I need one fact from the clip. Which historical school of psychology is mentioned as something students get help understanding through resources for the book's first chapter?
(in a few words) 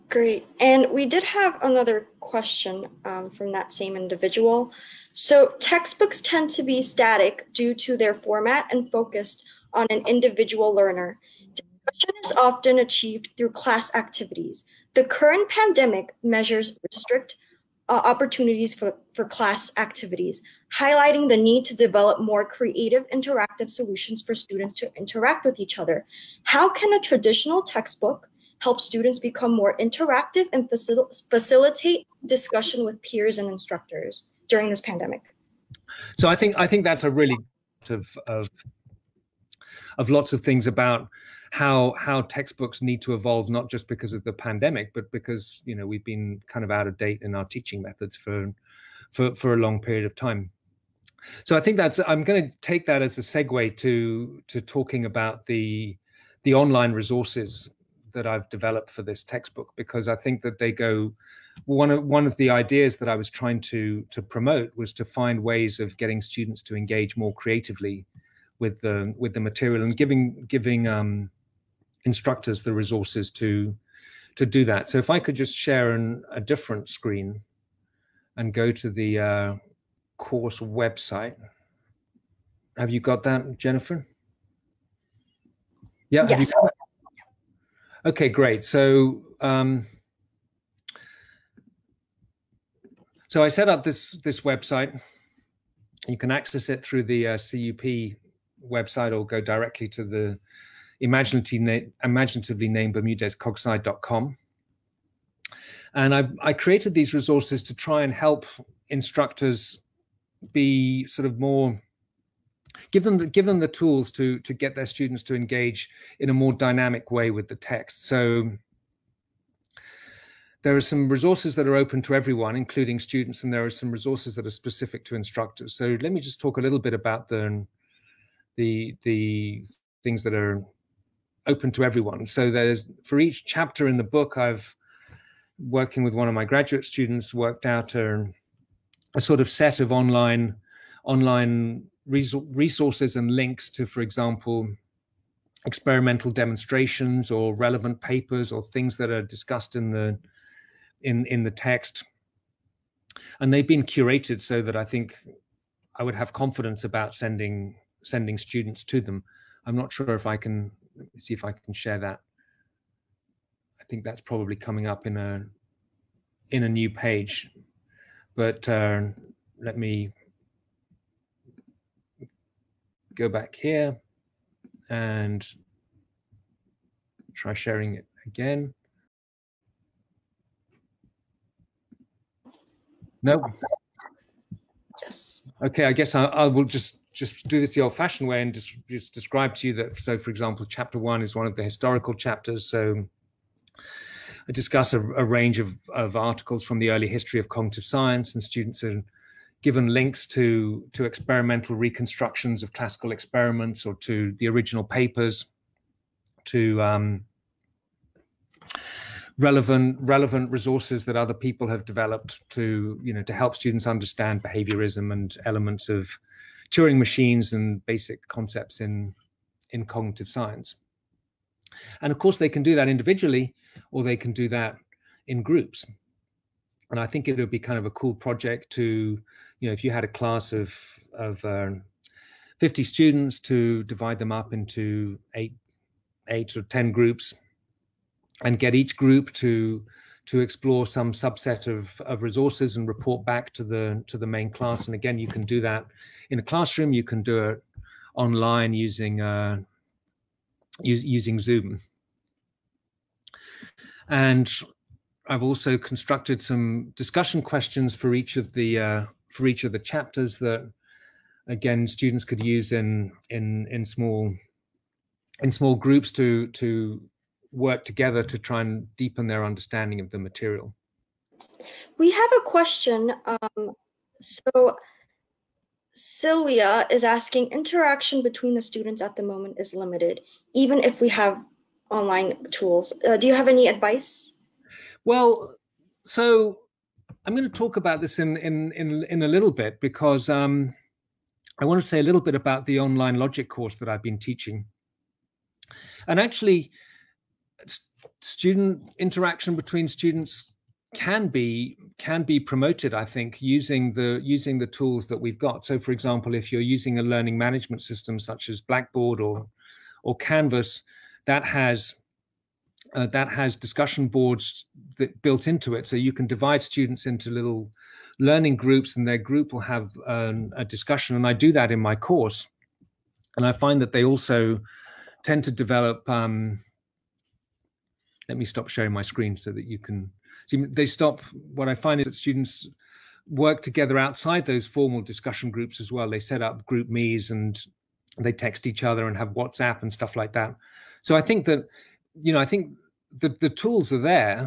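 behaviorism.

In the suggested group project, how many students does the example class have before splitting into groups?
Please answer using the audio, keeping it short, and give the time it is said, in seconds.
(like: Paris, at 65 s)
50, at 232 s.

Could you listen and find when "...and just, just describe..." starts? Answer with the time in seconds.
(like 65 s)
188 s.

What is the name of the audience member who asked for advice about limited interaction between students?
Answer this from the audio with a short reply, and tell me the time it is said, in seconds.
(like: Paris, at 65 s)
Sylvia, at 275 s.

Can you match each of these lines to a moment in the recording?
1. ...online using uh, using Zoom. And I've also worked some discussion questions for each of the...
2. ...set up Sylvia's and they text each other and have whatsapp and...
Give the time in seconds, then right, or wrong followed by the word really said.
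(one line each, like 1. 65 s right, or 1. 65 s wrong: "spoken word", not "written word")
1. 248 s wrong: "constructed", not "worked"
2. 336 s wrong: "GroupMe", not "Sylvia".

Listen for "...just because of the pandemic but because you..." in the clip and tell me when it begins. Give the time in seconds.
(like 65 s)
43 s.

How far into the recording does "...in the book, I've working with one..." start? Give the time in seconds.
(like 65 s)
133 s.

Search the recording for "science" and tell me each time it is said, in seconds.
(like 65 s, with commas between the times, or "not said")
197 s, 220 s.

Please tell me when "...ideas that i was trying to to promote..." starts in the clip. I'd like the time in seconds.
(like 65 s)
62 s.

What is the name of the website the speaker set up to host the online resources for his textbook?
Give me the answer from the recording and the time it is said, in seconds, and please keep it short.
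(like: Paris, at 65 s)
bermudezcogsci.com, at 102 s.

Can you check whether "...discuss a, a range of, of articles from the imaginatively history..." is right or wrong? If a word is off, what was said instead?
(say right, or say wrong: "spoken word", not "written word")
wrong: "early", not "imaginatively".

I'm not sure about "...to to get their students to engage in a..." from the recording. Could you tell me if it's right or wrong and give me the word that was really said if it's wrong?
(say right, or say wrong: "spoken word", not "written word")
right.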